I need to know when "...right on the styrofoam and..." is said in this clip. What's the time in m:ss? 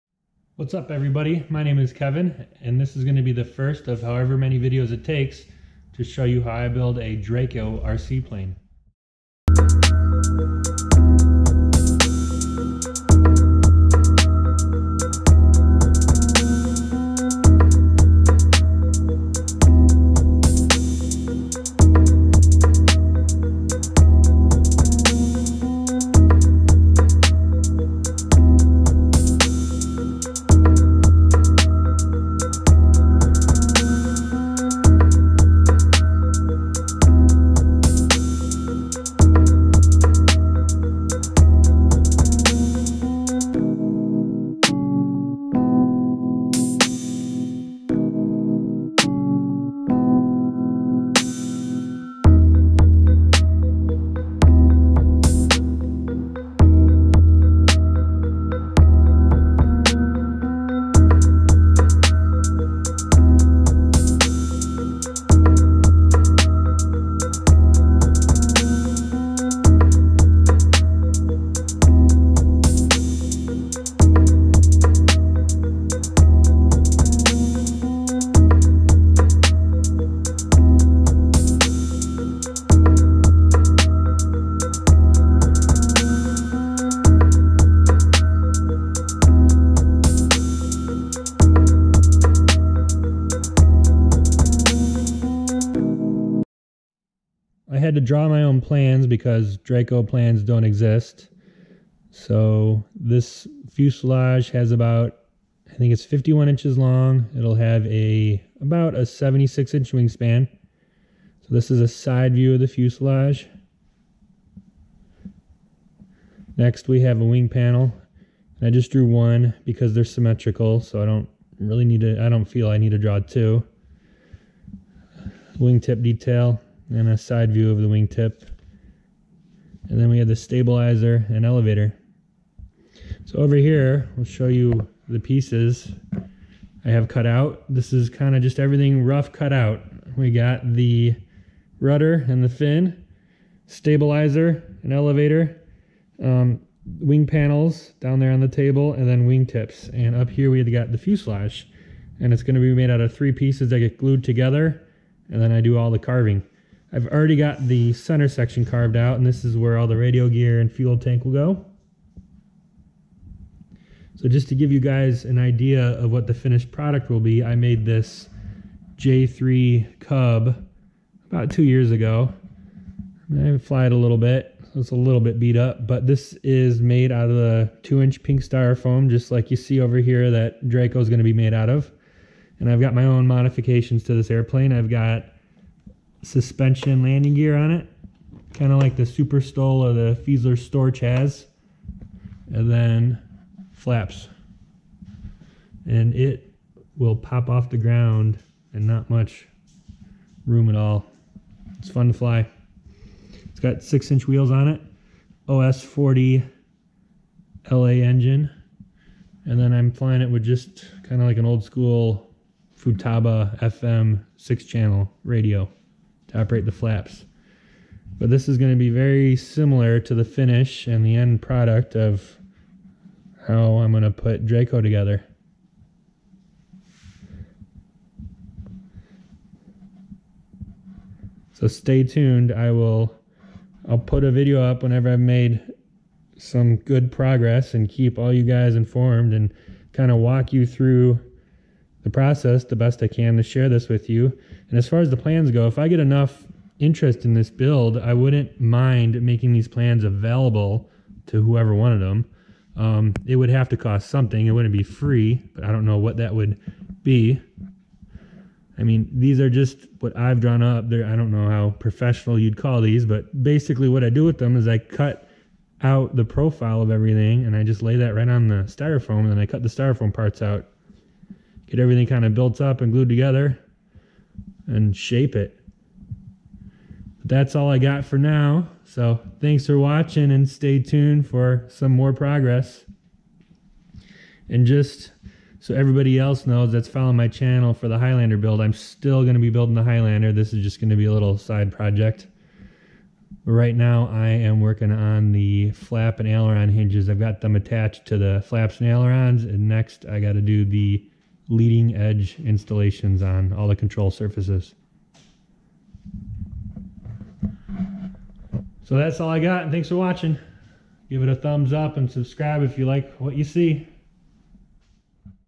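4:28.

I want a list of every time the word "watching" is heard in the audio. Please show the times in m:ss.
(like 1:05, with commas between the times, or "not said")
4:39, 5:09.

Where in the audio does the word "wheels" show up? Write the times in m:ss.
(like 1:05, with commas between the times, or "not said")
3:24.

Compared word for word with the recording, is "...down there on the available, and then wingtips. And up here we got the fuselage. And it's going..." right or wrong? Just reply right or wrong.
wrong.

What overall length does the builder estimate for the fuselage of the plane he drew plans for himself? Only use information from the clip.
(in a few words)
51 inches.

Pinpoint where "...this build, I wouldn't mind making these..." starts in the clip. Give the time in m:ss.
4:07.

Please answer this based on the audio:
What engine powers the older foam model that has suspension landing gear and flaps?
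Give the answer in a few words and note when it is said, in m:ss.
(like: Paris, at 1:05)
OS 40 LA, at 3:25.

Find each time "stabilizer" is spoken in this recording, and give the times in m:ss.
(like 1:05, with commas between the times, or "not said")
2:10, 2:23.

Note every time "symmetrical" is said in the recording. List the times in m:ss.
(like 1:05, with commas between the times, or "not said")
2:00.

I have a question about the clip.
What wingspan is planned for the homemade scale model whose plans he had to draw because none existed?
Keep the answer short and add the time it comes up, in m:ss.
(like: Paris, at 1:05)
76 inches, at 1:49.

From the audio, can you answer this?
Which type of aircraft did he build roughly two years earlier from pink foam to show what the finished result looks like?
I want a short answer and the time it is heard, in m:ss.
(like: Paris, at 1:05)
J3 Cub, at 2:48.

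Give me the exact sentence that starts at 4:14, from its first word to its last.
It wouldn't be free, but I don't know what that would be.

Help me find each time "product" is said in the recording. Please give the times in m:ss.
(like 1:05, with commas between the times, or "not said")
2:46, 3:41.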